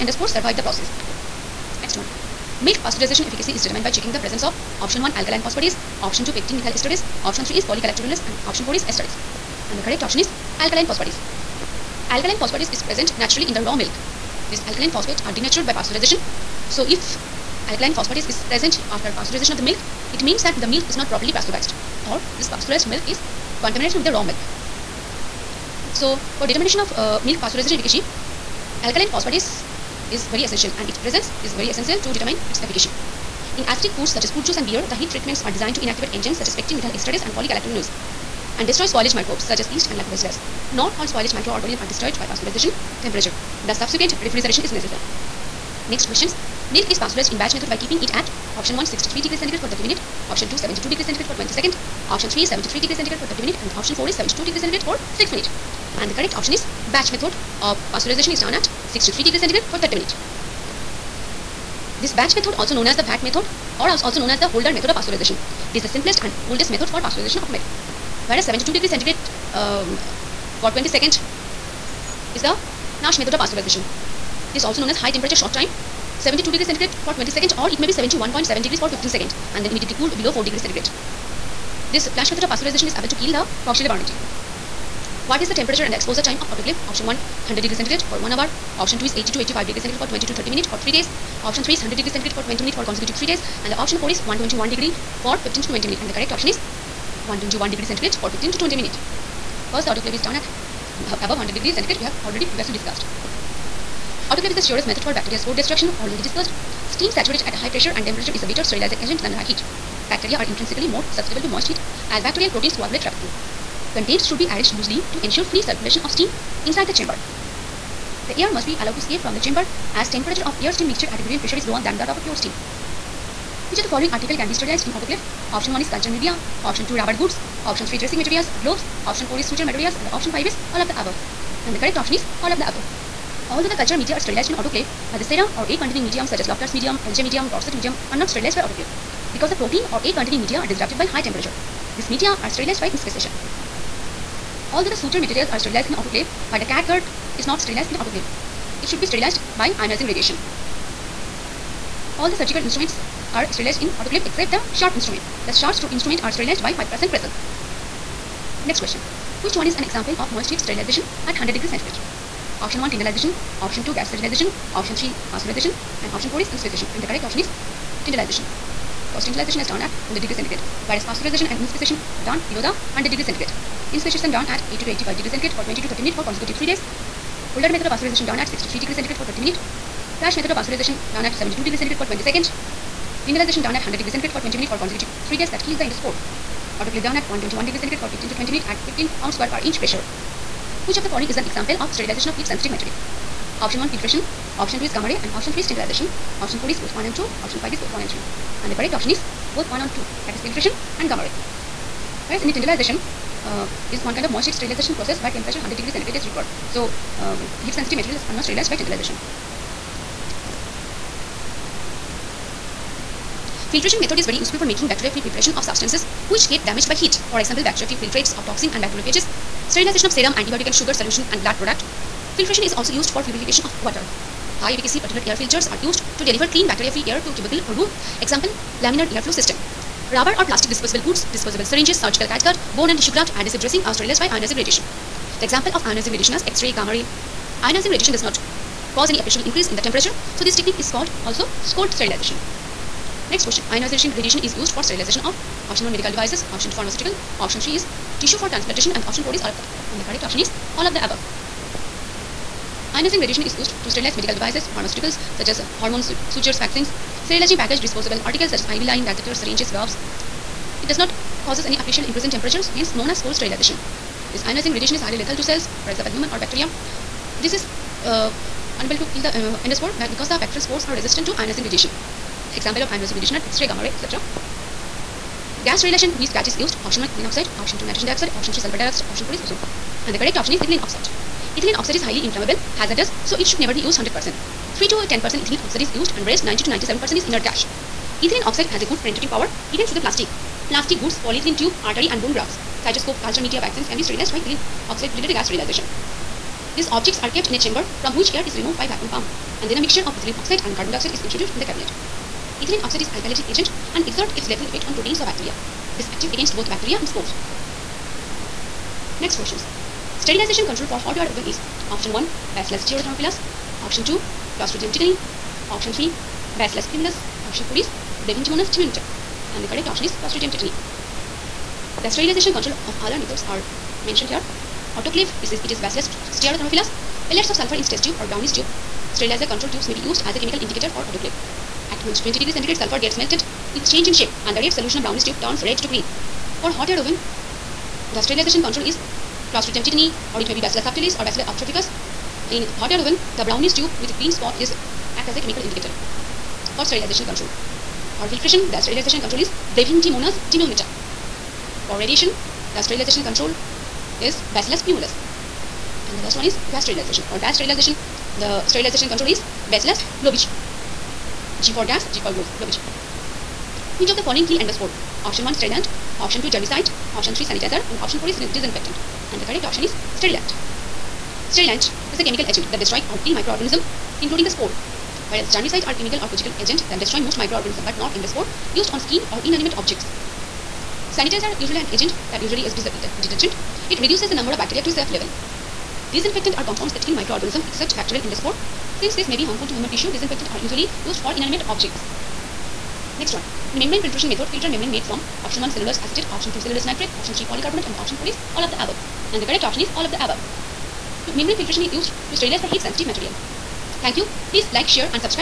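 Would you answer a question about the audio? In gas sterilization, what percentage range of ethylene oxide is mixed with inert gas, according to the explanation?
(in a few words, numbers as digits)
3 to 10%.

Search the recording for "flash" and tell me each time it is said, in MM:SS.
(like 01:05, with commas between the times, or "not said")
01:12, 01:22, 03:00.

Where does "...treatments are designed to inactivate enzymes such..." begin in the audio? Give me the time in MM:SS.
00:35.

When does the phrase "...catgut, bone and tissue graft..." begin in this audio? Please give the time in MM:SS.
03:52.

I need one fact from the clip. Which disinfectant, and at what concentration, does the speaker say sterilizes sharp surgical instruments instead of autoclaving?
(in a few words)
5% Cresol.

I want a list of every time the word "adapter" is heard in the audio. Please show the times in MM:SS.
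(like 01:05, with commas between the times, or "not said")
not said.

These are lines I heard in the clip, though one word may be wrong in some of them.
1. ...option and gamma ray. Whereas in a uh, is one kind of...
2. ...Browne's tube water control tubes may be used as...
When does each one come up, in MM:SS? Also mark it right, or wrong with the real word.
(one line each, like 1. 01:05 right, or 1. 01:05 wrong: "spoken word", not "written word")
1. 03:20 wrong: "filtration", not "option"
2. 05:28 wrong: "sterilizer", not "water".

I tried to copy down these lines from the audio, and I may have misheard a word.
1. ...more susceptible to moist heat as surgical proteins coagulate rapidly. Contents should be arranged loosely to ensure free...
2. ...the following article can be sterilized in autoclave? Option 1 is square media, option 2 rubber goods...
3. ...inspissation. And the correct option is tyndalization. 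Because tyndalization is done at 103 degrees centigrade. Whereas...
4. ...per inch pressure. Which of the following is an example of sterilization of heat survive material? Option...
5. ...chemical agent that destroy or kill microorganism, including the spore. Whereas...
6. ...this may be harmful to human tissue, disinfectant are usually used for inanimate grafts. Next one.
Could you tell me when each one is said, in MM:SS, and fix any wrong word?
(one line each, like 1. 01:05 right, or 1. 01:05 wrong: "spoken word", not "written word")
1. 01:50 wrong: "bacterial", not "surgical"
2. 02:03 wrong: "culture", not "square"
3. 02:46 wrong: "100", not "103"
4. 03:09 wrong: "sensitive", not "survive"
5. 06:12 right
6. 06:29 wrong: "objects", not "grafts".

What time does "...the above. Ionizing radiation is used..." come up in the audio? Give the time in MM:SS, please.
04:10.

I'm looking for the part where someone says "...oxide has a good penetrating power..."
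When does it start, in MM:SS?
04:48.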